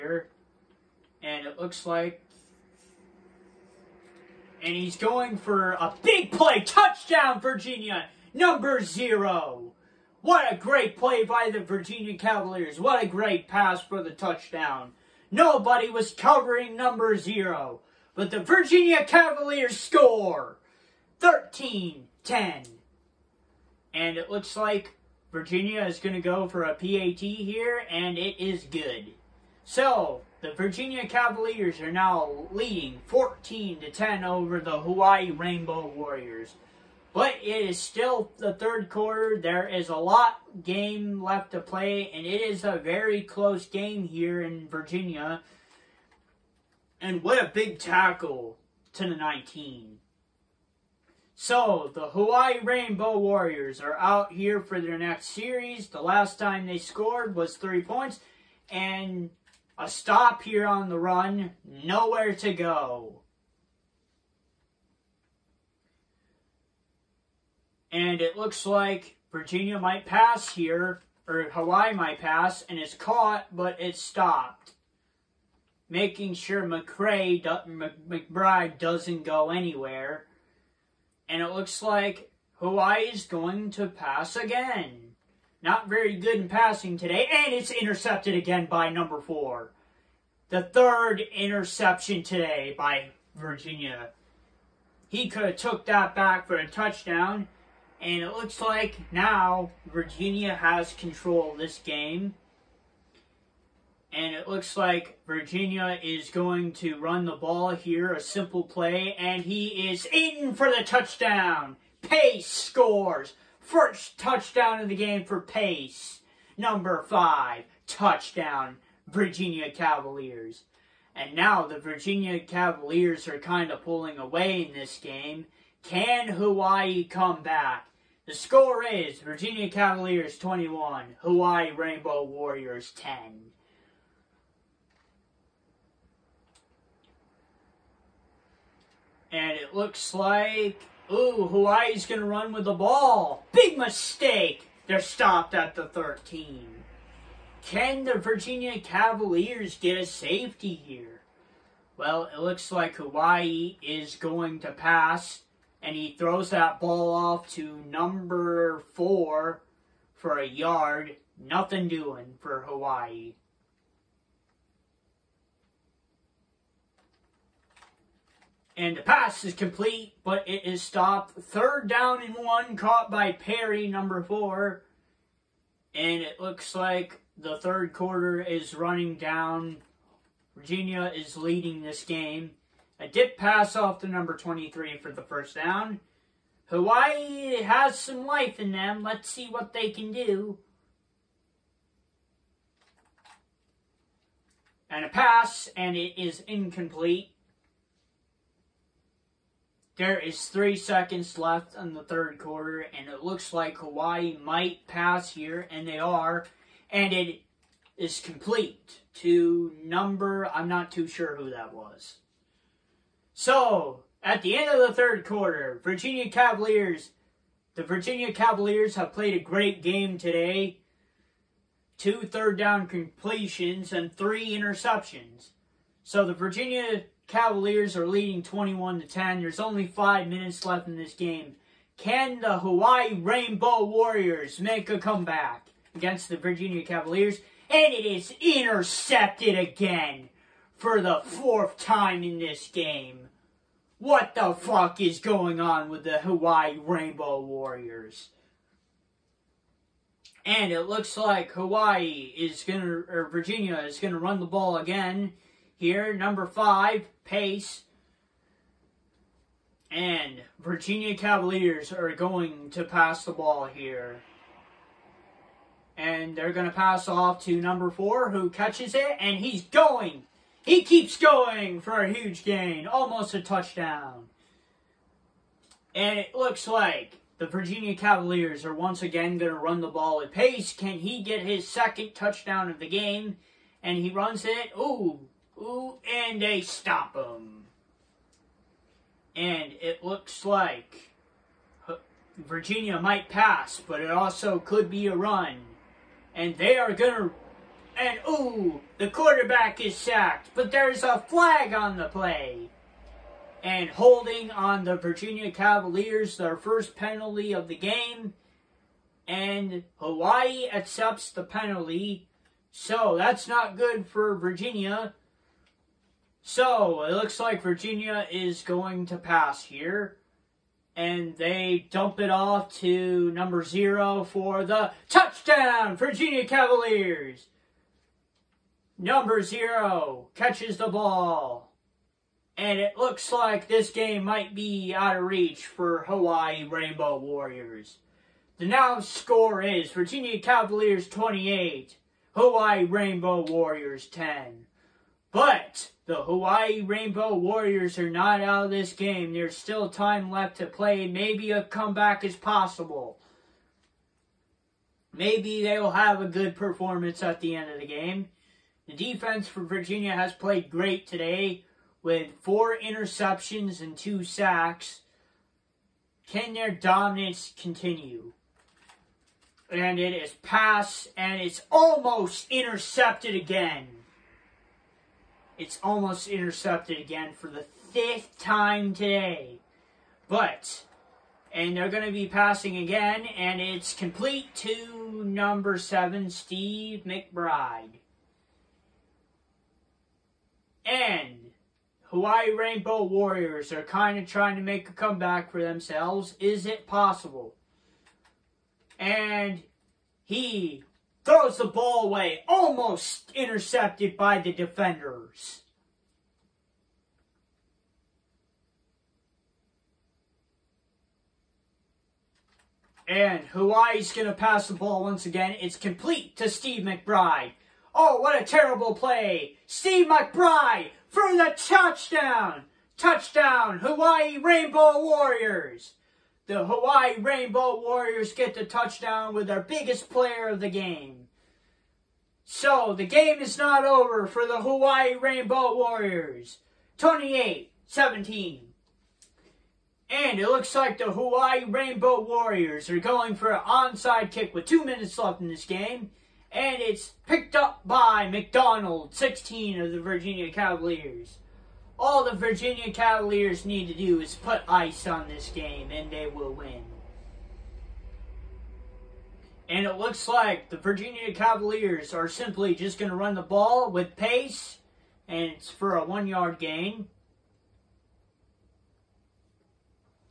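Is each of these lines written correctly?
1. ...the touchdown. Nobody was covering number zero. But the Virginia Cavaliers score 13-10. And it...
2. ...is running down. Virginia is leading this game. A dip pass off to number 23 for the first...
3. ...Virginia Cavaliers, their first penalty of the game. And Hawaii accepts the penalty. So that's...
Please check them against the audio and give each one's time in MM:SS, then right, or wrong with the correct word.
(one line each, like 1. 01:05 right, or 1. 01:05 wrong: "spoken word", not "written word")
1. 00:14 right
2. 02:58 right
3. 05:04 right.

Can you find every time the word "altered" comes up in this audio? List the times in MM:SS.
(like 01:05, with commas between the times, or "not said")
not said.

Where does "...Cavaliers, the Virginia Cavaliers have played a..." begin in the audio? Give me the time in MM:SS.
03:36.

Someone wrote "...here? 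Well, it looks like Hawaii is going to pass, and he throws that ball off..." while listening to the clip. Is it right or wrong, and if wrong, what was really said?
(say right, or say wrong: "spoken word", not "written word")
right.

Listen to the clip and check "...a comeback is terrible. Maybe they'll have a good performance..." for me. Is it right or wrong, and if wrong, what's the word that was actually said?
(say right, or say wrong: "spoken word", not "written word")
wrong: "possible", not "terrible".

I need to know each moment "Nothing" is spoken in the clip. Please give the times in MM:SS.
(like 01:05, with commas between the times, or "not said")
02:41.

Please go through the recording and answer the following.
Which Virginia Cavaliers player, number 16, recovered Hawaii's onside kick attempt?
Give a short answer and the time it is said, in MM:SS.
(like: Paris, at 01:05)
McDonald, at 07:28.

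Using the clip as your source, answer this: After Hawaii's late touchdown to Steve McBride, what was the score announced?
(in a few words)
28-17.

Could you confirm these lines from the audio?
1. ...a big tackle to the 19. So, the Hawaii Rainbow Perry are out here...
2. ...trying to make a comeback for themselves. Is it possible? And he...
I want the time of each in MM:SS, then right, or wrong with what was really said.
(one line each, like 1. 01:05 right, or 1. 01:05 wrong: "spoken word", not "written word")
1. 00:47 wrong: "Warriors", not "Perry"
2. 06:34 right.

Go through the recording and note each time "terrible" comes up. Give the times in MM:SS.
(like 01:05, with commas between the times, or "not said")
06:58.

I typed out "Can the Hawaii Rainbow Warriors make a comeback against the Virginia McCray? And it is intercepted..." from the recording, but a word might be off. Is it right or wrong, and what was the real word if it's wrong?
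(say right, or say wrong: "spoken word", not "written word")
wrong: "Cavaliers", not "McCray".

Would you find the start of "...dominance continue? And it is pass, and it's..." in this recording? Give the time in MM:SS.
06:06.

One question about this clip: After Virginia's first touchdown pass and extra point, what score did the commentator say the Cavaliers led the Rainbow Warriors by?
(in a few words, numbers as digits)
14 to 10.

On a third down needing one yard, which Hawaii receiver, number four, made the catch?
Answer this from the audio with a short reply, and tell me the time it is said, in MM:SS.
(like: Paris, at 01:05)
Perry, at 02:53.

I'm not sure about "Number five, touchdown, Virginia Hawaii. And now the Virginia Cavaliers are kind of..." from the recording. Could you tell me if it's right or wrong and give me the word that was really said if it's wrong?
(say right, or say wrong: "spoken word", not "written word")
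wrong: "Cavaliers", not "Hawaii".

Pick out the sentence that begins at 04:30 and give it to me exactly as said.
He keeps going for a huge gain, almost a touchdown.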